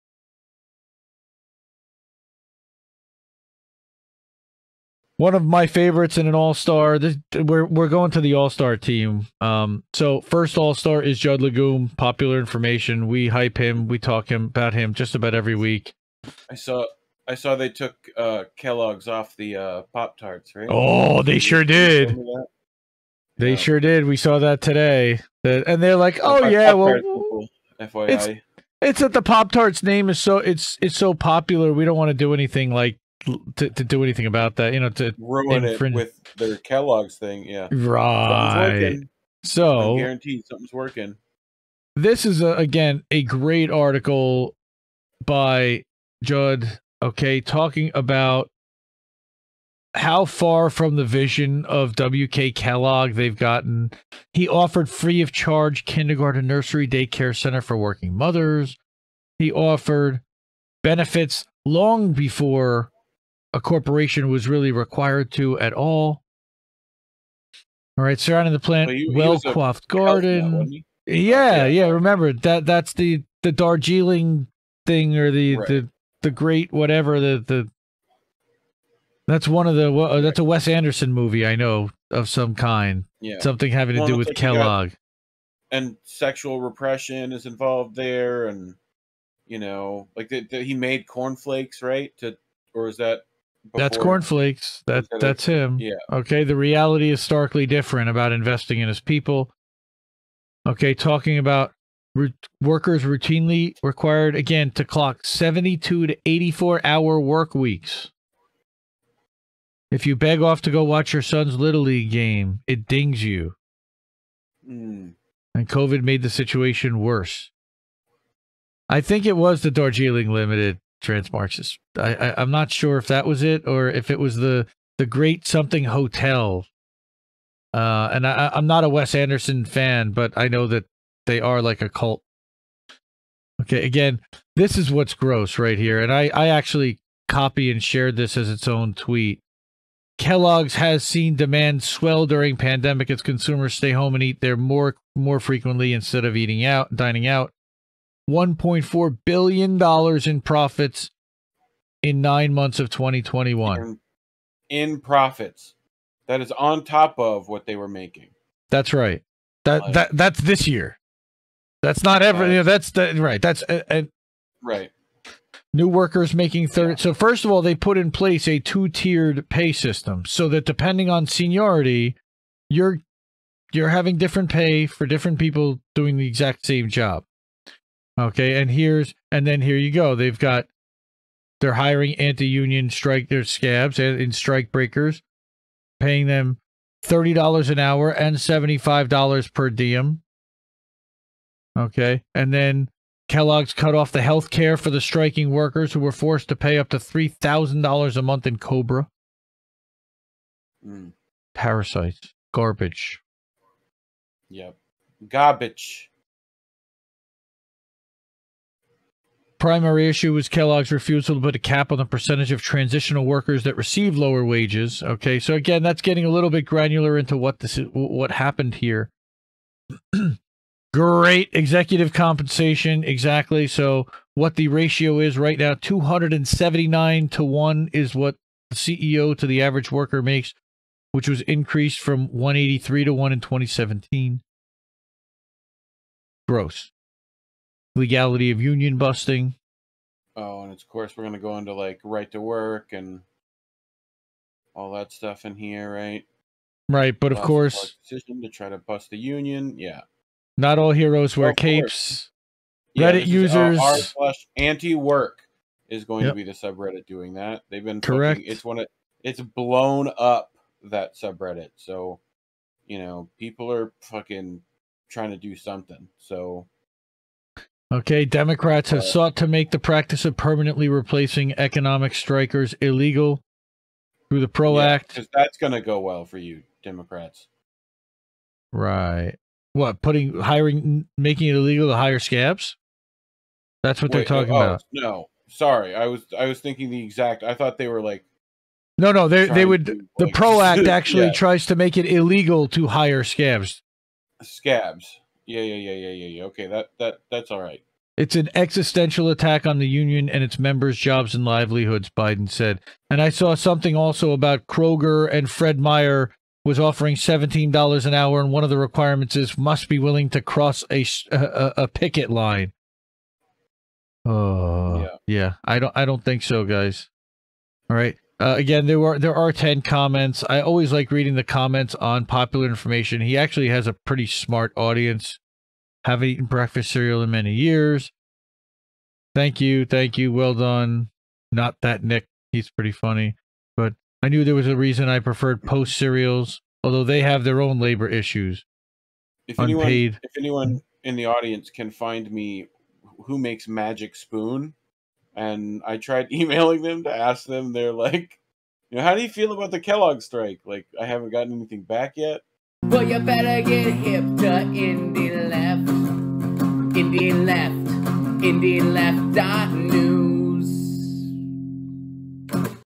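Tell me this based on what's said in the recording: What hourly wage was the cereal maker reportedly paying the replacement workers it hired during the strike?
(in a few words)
$30.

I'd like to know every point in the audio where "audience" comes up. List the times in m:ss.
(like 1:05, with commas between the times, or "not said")
5:24, 5:41.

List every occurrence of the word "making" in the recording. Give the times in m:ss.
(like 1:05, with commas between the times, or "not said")
2:37, 2:46, 4:41.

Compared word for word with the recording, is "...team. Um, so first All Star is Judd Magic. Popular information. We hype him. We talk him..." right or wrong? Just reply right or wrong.
wrong.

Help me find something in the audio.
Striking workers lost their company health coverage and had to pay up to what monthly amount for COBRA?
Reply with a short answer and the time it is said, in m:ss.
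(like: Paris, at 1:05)
$3,000, at 3:16.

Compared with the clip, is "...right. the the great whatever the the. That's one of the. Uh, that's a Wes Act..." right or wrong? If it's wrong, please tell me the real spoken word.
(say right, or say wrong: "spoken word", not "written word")
wrong: "Anderson", not "Act".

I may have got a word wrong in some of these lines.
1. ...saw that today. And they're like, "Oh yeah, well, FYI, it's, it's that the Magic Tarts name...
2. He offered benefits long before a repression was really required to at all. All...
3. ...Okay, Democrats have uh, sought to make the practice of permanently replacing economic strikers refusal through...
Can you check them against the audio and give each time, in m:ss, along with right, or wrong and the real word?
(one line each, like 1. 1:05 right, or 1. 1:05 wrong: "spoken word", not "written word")
1. 0:24 wrong: "Pop", not "Magic"
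2. 0:59 wrong: "corporation", not "repression"
3. 4:27 wrong: "illegal", not "refusal".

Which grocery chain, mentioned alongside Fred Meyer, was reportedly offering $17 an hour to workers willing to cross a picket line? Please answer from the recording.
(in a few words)
Kroger.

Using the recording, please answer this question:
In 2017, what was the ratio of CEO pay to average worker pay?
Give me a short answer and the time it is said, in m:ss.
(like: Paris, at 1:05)
183 to 1, at 3:52.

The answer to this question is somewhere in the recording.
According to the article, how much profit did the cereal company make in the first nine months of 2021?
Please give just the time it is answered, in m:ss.
2:28.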